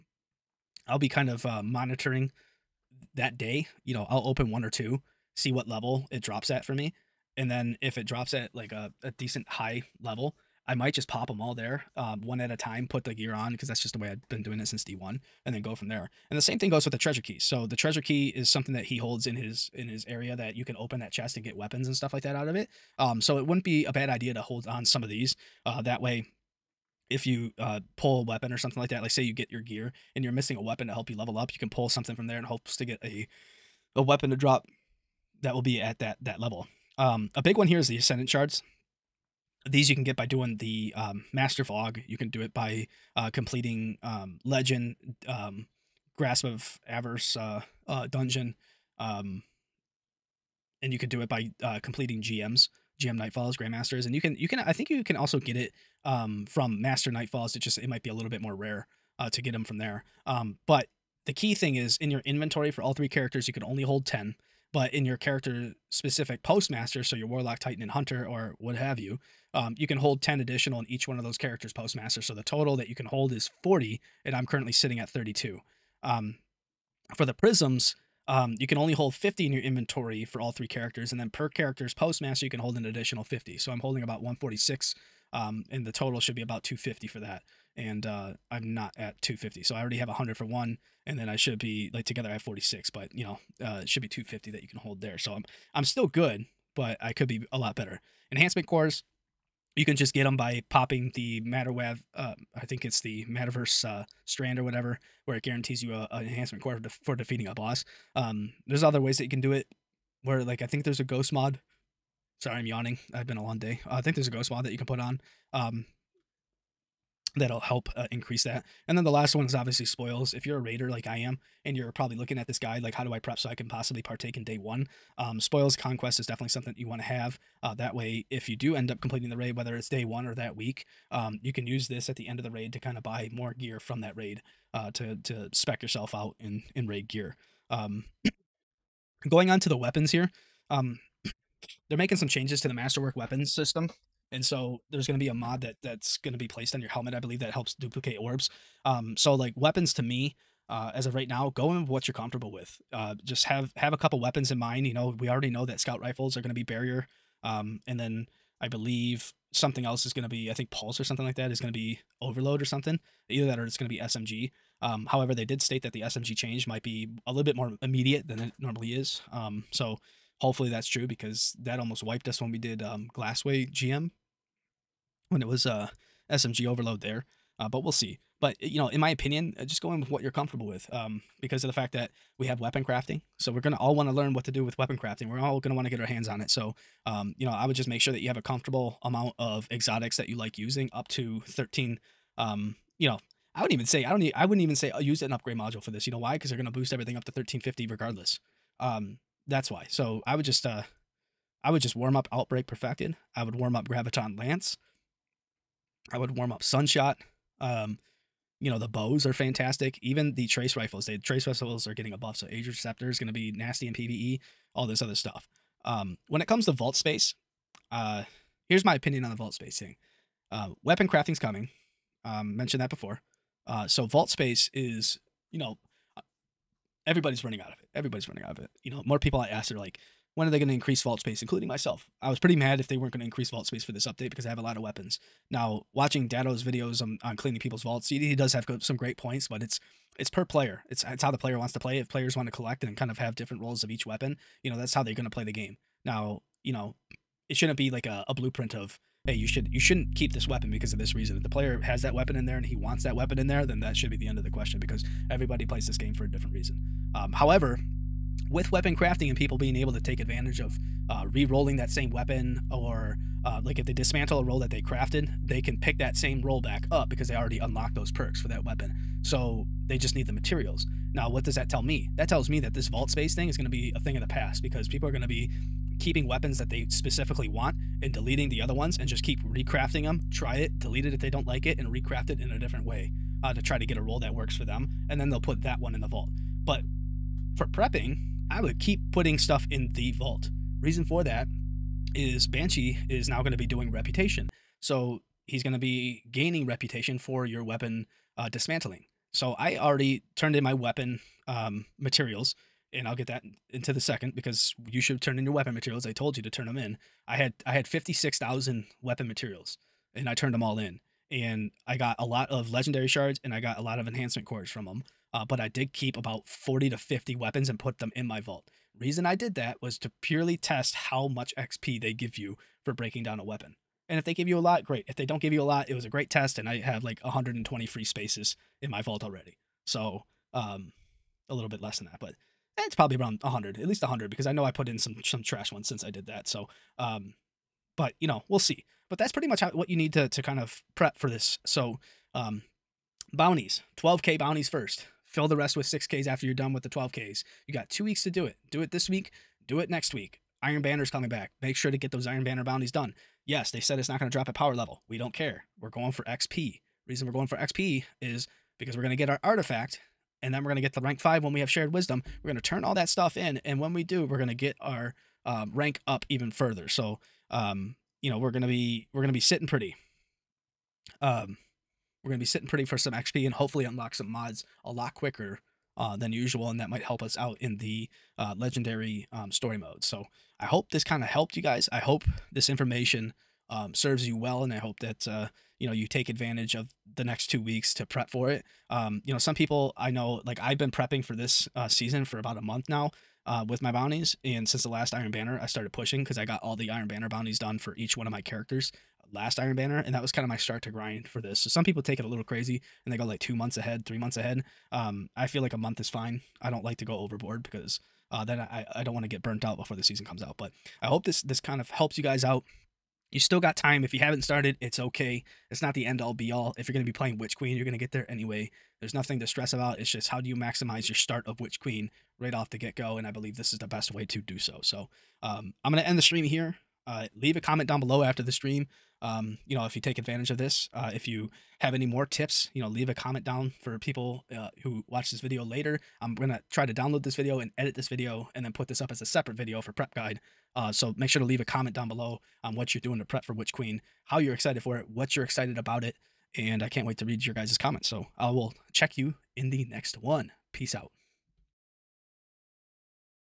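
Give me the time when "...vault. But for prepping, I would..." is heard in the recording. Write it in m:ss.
4:46.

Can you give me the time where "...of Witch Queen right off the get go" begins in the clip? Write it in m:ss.
7:01.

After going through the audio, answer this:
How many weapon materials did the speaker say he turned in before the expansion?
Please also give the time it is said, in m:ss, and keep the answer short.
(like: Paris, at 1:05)
56,000, at 5:07.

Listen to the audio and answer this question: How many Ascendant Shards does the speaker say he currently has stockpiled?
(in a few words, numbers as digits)
32.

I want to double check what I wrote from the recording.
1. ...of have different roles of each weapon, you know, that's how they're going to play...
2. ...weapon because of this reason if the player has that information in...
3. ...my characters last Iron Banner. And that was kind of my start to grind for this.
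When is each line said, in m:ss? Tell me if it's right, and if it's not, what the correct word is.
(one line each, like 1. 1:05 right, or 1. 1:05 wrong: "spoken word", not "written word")
1. 4:03 right
2. 4:10 wrong: "weapon", not "information"
3. 6:38 right.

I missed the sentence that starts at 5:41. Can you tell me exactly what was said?
So, um, bounties, 12k bounties first.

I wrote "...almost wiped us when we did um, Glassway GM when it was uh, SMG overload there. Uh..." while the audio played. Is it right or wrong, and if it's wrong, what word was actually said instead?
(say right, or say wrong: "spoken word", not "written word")
right.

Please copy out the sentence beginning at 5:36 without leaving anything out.
So, um, but you know, we'll see.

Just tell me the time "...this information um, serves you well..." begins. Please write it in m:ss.
6:22.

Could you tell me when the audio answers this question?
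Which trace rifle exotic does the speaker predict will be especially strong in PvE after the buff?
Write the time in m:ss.
3:32.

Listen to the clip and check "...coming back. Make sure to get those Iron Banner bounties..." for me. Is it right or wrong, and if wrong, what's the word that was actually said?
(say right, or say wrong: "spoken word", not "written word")
right.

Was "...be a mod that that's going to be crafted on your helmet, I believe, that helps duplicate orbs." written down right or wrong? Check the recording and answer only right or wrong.
wrong.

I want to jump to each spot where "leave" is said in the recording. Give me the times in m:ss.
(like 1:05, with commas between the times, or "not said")
7:07, 7:12, 7:21.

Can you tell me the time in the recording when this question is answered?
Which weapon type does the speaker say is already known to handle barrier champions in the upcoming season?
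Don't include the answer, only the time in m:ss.
2:35.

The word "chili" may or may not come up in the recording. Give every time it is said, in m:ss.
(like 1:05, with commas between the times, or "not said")
not said.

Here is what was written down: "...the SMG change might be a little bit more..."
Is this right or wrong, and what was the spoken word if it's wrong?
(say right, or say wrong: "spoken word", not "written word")
right.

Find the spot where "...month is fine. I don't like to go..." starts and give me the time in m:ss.
6:45.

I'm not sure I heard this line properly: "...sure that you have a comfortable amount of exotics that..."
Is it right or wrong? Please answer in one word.
right.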